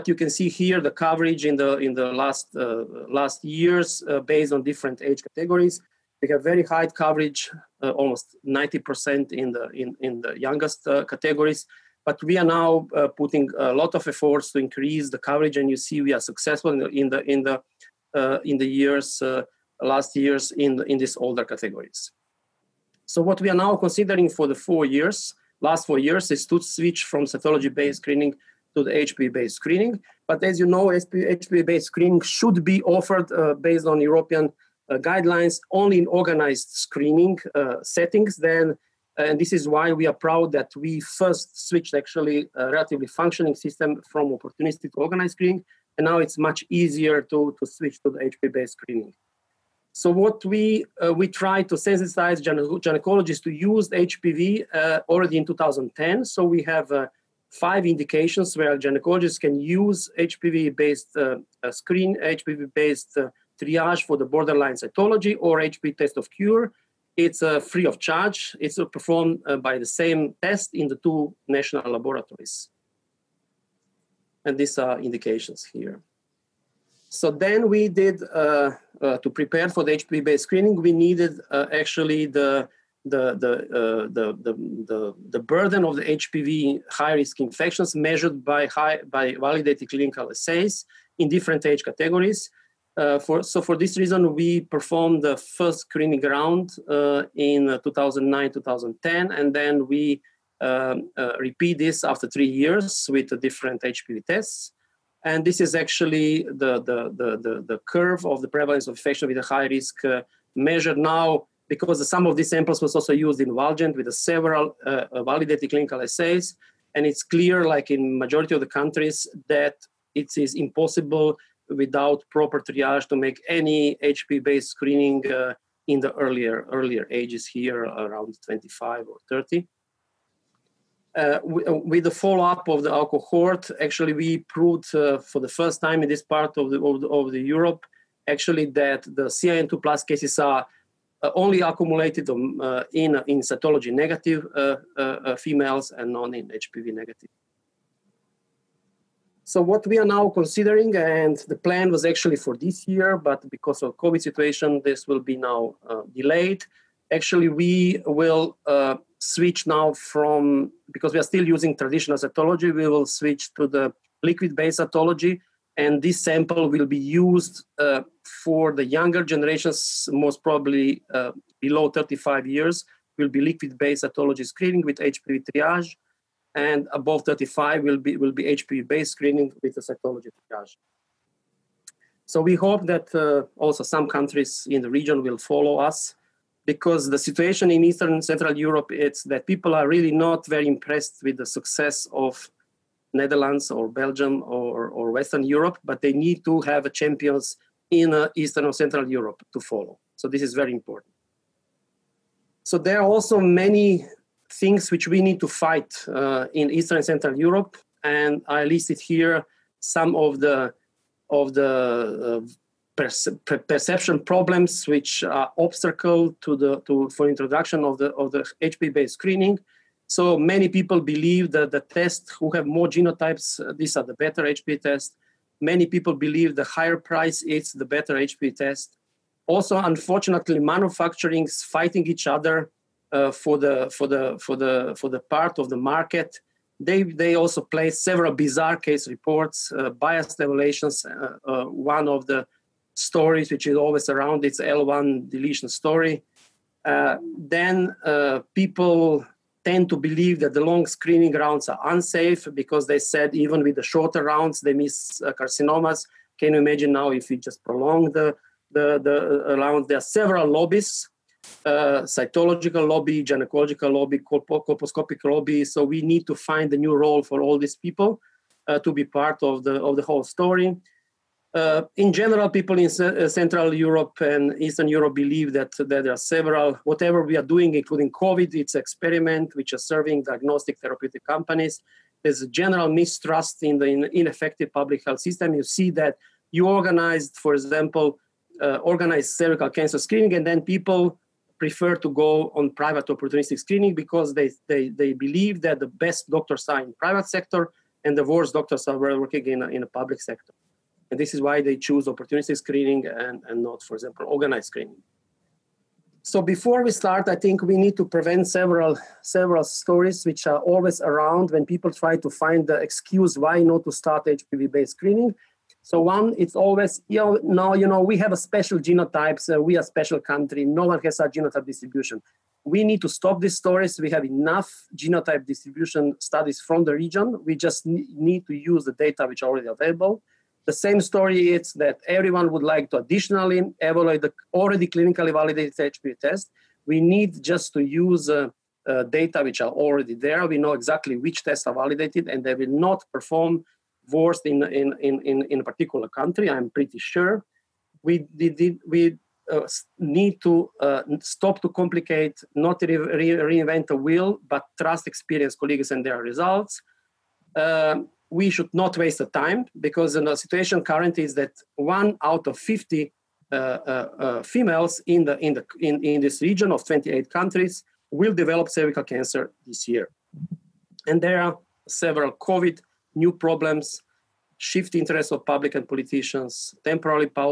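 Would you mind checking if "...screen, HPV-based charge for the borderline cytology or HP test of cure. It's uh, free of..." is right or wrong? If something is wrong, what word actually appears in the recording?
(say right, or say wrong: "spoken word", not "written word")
wrong: "triage", not "charge".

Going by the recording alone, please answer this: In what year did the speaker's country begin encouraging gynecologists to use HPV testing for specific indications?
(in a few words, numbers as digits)
2010.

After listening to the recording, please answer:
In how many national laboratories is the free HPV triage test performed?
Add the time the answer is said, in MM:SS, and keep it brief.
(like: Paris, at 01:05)
2, at 01:10.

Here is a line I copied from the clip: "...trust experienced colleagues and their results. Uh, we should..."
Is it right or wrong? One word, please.
right.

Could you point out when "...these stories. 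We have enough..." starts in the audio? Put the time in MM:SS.
05:23.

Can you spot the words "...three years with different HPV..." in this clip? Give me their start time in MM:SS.
01:42.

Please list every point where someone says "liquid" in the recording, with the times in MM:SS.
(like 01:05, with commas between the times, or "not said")
02:44, 02:53.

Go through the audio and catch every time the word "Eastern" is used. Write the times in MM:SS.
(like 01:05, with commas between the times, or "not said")
03:07, 03:18, 03:26, 04:34.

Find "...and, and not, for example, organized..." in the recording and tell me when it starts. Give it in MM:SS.
05:03.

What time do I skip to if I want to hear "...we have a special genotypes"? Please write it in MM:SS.
05:18.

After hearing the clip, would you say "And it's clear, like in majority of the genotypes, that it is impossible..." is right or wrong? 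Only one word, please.
wrong.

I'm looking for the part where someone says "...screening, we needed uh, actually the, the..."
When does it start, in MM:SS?
01:20.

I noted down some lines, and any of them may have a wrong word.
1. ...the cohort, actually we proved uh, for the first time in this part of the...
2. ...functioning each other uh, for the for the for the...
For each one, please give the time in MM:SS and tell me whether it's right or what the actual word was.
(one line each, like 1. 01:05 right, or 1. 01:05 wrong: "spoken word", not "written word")
1. 02:12 right
2. 03:51 wrong: "fighting", not "functioning".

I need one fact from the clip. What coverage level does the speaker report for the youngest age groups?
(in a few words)
90%.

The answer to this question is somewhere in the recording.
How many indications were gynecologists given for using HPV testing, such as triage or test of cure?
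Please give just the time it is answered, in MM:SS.
00:57.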